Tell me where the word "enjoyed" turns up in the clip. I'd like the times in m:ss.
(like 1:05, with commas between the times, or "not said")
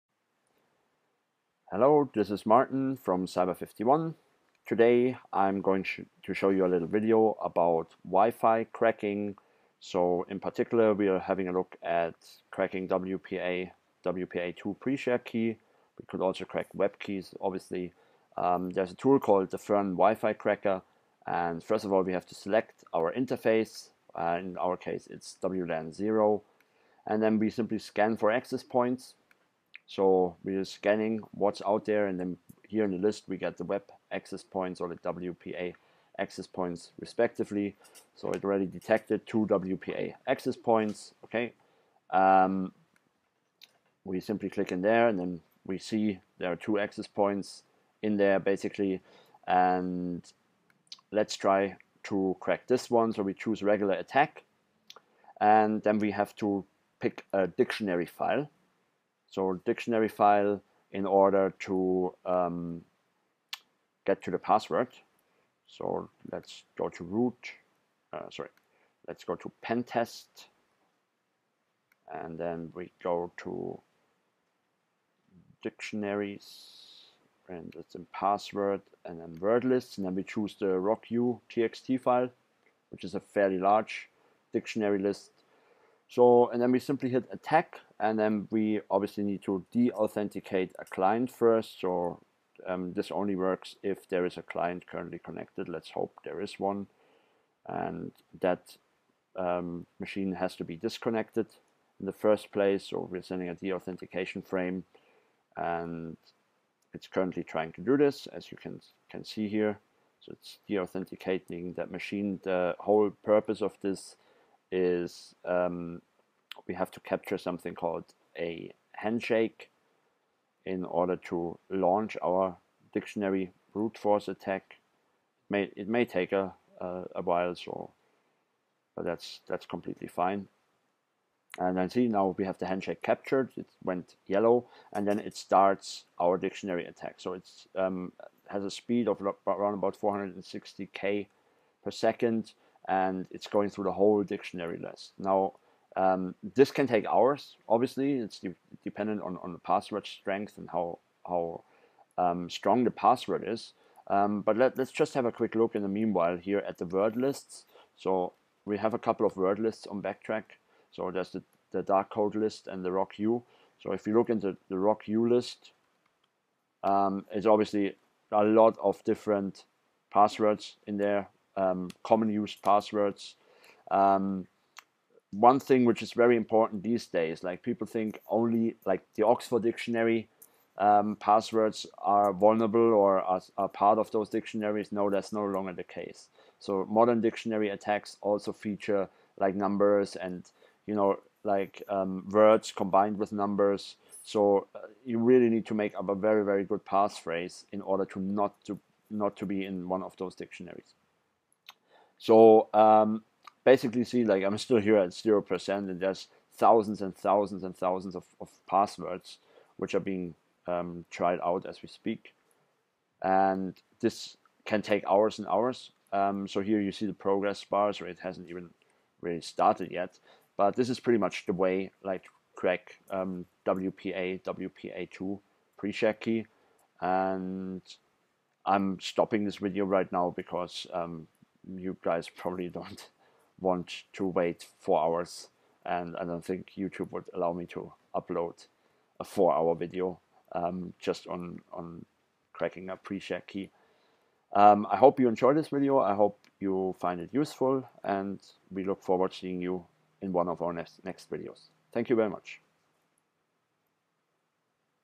4:05.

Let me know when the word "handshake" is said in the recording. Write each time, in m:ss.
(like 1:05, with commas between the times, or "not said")
1:58, 2:12.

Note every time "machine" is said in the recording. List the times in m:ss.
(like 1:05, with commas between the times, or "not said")
1:40, 1:51.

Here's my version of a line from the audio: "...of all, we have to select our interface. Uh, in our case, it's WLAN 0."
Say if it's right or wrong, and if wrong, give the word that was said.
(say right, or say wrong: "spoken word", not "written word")
right.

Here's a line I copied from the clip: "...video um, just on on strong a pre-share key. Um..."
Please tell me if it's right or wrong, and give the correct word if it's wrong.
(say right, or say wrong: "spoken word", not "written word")
wrong: "cracking", not "strong".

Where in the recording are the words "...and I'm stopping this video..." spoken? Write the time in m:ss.
3:47.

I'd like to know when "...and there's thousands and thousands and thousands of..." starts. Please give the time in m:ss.
3:25.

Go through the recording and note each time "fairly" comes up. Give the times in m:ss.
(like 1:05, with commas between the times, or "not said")
1:23.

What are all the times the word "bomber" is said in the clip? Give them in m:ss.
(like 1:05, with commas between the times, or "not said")
not said.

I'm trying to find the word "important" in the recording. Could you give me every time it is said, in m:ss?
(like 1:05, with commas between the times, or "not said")
2:56.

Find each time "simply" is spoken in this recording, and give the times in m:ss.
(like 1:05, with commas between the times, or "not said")
0:27, 0:44, 1:26.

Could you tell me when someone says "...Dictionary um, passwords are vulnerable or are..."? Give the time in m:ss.
2:59.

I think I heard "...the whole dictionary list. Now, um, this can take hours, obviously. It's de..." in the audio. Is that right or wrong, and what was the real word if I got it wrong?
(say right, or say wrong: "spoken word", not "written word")
right.